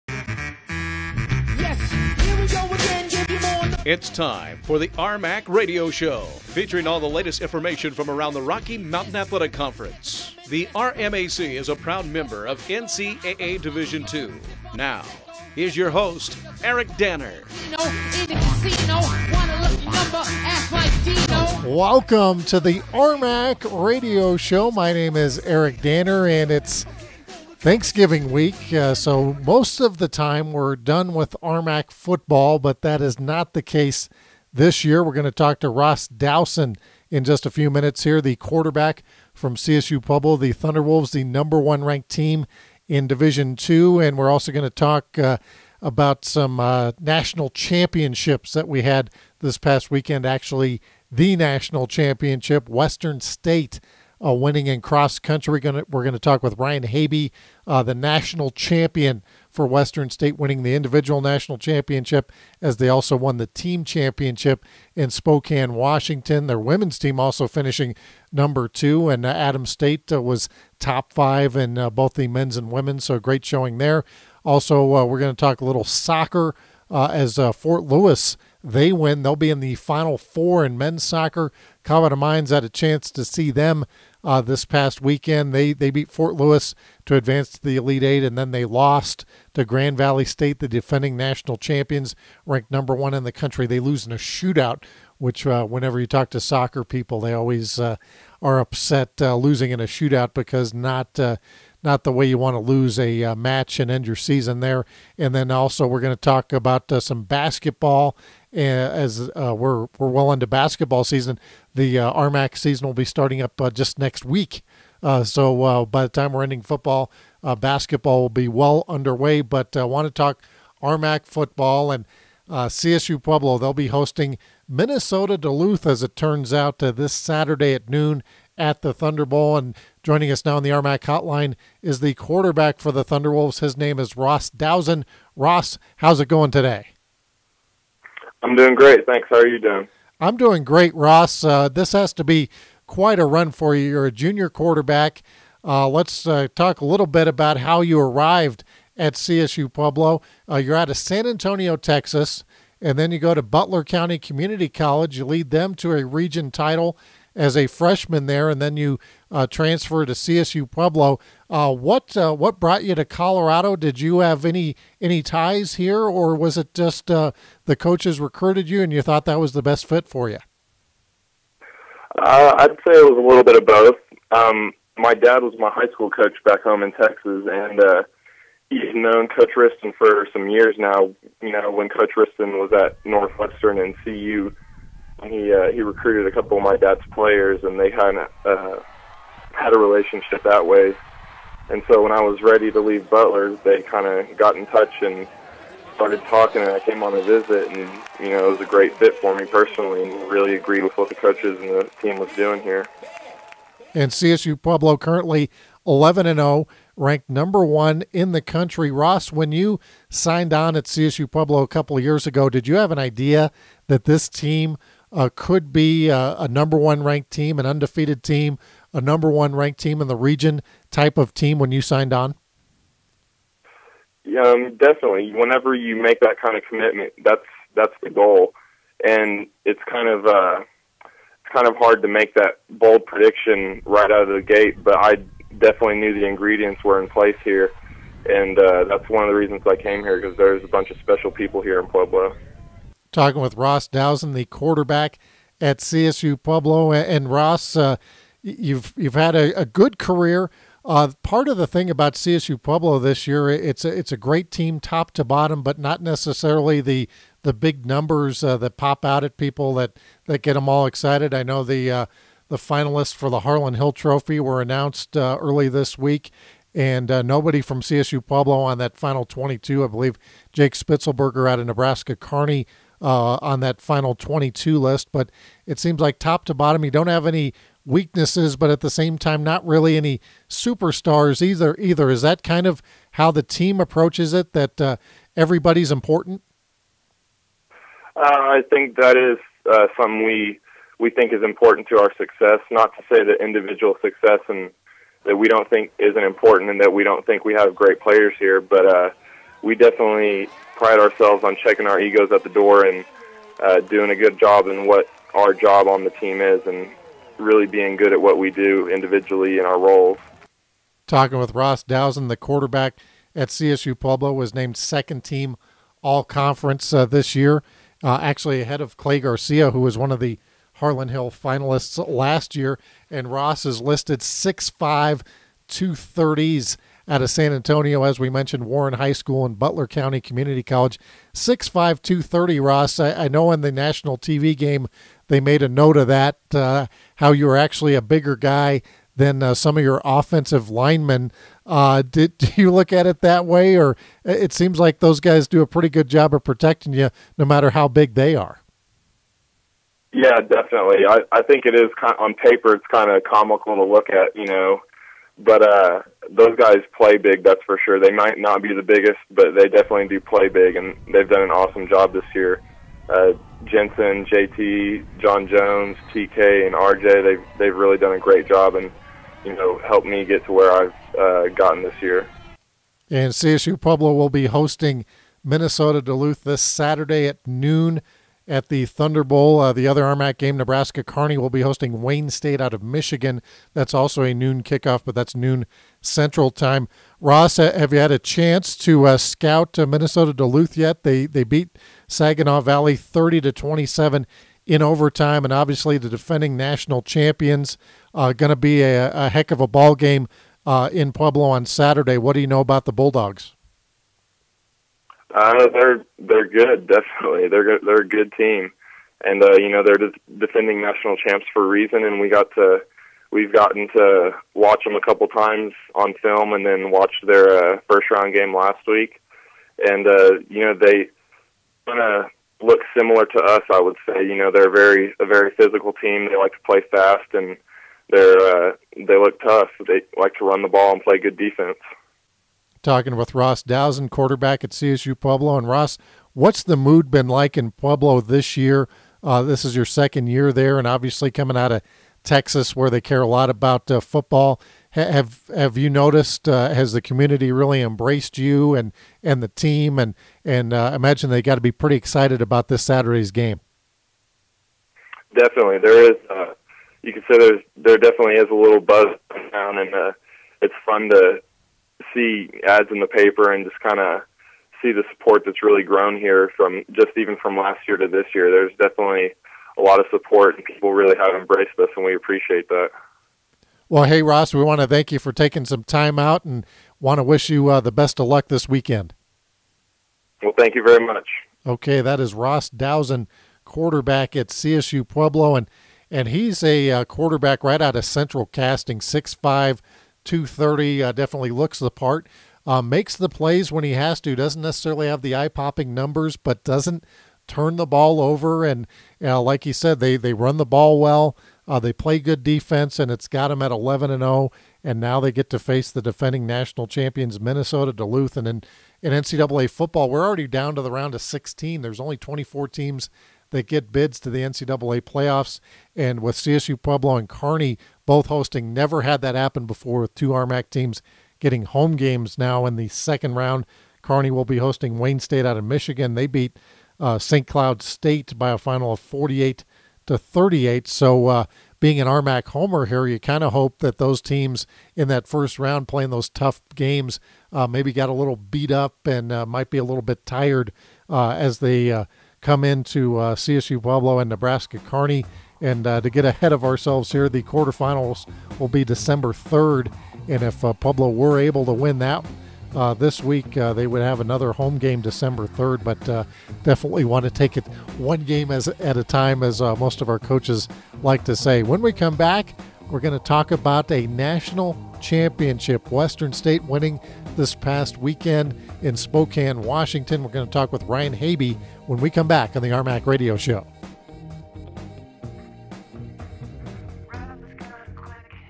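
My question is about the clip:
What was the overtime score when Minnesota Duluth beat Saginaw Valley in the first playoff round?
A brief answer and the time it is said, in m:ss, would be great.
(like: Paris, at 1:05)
30-27, at 6:32.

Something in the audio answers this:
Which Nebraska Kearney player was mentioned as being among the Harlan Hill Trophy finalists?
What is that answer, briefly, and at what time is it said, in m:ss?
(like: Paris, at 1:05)
Jake Spitzelberger, at 4:30.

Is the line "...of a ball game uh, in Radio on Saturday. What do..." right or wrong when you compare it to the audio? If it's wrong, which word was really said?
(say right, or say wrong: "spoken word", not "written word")
wrong: "Pueblo", not "Radio".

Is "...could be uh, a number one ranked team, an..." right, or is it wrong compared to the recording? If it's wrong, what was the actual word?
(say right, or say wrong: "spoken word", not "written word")
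right.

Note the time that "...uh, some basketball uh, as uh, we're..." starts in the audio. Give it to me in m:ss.
1:46.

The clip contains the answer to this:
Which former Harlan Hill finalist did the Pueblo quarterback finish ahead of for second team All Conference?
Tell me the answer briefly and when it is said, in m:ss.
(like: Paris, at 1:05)
Clay Garcia, at 5:18.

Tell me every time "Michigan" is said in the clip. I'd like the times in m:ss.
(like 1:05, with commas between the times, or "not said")
6:22, 8:45.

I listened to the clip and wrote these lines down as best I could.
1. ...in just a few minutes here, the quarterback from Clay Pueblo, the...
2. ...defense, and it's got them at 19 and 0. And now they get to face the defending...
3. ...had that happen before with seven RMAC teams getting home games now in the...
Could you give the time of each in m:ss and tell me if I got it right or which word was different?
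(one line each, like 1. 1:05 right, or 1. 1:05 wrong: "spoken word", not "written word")
1. 0:37 wrong: "CSU", not "Clay"
2. 8:22 wrong: "11", not "19"
3. 8:39 wrong: "two", not "seven".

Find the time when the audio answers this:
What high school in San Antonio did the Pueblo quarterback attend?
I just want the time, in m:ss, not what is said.
5:28.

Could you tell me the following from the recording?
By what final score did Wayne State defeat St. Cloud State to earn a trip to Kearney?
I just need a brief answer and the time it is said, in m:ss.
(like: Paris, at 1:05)
48-38, at 8:48.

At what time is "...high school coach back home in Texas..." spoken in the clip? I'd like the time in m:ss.
2:55.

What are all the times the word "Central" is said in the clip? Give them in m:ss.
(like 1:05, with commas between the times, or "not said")
6:26, 8:08.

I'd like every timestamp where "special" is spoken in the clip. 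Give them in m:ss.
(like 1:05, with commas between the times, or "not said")
4:00.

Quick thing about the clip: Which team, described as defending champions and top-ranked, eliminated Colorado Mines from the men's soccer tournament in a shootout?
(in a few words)
Grand Valley State.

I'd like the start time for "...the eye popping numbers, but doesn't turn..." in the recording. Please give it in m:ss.
8:15.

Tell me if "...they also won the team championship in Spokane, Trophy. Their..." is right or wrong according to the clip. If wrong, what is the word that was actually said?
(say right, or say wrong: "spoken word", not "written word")
wrong: "Washington", not "Trophy".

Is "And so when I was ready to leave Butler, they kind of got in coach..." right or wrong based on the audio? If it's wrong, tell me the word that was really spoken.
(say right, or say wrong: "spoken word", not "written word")
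wrong: "touch", not "coach".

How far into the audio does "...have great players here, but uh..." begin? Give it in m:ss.
4:57.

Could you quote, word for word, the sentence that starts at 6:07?
They've they've really done a great job and you know helped me get to where I've uh, gotten this year.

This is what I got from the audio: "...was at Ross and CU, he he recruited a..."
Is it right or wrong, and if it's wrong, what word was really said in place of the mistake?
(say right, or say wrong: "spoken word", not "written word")
wrong: "Northwestern", not "Ross".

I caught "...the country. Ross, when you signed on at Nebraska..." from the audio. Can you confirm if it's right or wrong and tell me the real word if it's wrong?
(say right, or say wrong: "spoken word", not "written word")
wrong: "CSU", not "Nebraska".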